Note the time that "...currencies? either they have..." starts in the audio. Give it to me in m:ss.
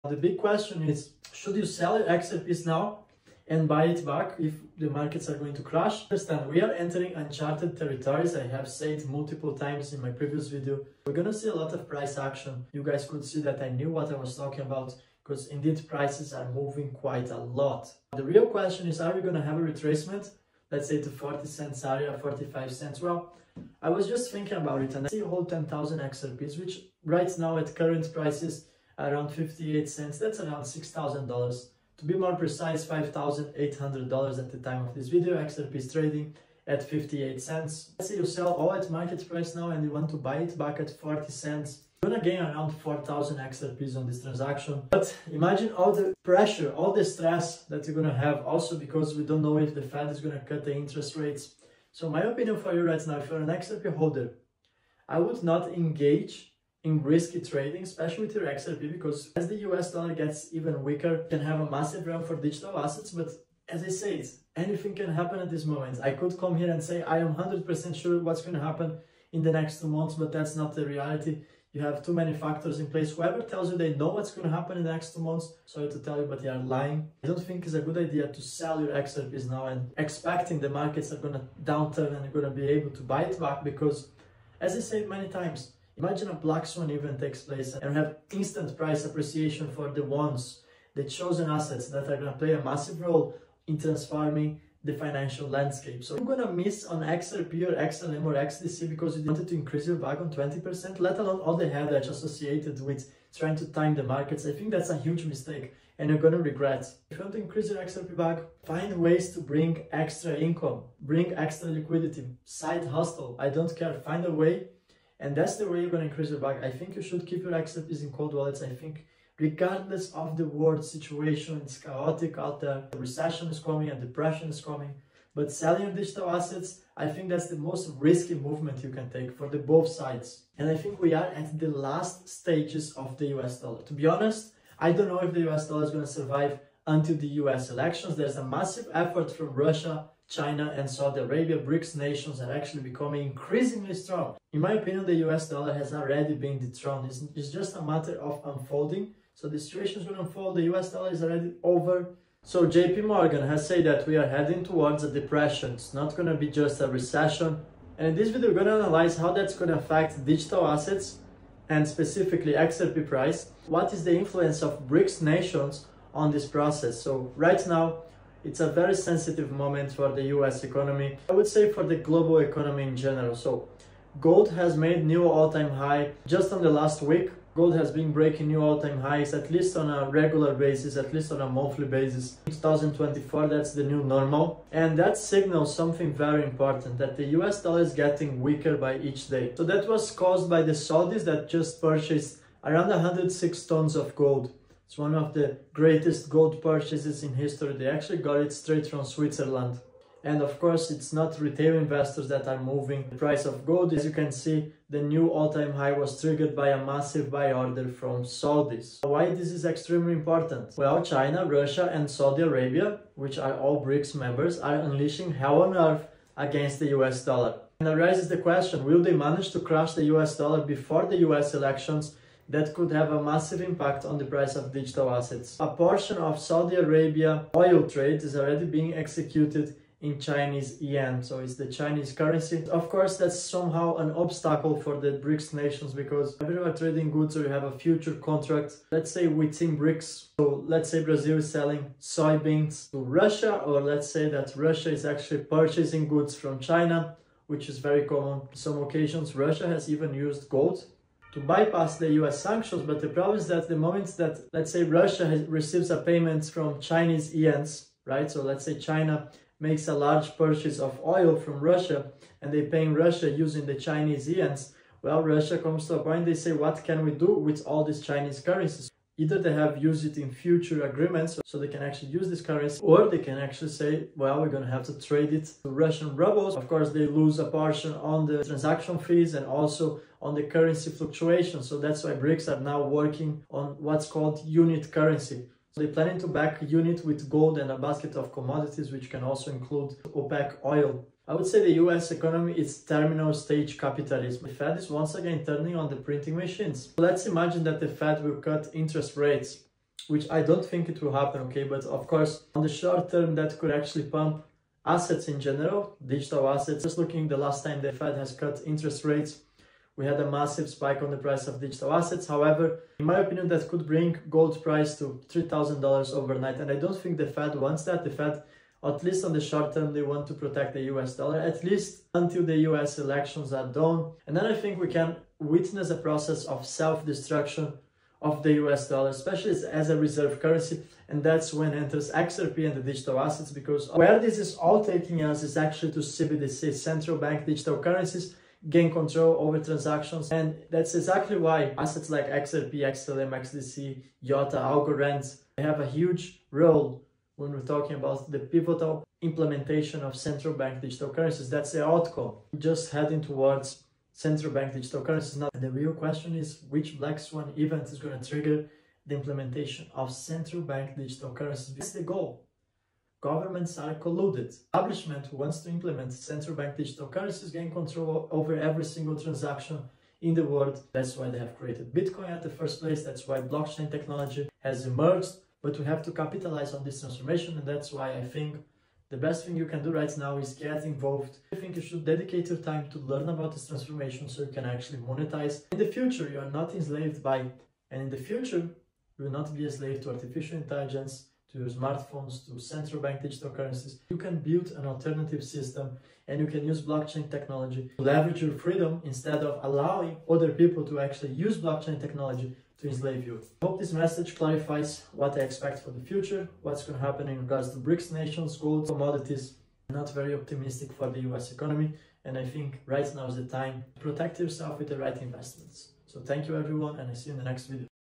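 4:28.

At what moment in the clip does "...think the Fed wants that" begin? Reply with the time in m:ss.
5:16.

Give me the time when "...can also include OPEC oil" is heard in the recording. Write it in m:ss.
4:49.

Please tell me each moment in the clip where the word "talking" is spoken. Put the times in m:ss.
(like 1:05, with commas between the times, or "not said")
0:14, 5:47.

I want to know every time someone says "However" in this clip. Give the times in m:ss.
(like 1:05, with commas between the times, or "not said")
5:12.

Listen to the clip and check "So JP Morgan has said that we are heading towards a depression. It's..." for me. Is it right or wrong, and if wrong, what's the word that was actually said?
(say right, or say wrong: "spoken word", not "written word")
right.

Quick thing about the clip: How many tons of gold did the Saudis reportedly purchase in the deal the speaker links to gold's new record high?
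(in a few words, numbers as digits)
106 tons.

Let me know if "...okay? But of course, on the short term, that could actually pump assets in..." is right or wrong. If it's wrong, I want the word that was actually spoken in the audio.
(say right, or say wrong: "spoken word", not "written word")
right.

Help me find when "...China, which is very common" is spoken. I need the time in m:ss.
4:06.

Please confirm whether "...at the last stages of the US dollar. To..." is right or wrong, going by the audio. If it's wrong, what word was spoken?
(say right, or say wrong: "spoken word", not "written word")
right.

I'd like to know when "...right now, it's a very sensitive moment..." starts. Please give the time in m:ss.
2:47.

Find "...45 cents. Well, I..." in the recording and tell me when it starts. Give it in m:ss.
0:22.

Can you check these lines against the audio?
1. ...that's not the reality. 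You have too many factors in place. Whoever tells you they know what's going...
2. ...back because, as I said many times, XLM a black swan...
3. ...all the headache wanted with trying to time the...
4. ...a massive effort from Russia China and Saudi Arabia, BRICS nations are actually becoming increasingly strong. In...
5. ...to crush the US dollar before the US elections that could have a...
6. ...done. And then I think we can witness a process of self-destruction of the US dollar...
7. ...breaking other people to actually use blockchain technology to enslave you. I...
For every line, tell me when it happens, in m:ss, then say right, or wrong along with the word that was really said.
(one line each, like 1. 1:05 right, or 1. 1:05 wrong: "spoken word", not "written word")
1. 1:10 right
2. 1:23 wrong: "Imagine", not "XLM"
3. 1:41 wrong: "associated", not "wanted"
4. 2:18 right
5. 3:39 right
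6. 5:23 right
7. 6:39 wrong: "allowing", not "breaking".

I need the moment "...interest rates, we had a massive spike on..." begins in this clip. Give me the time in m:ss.
5:08.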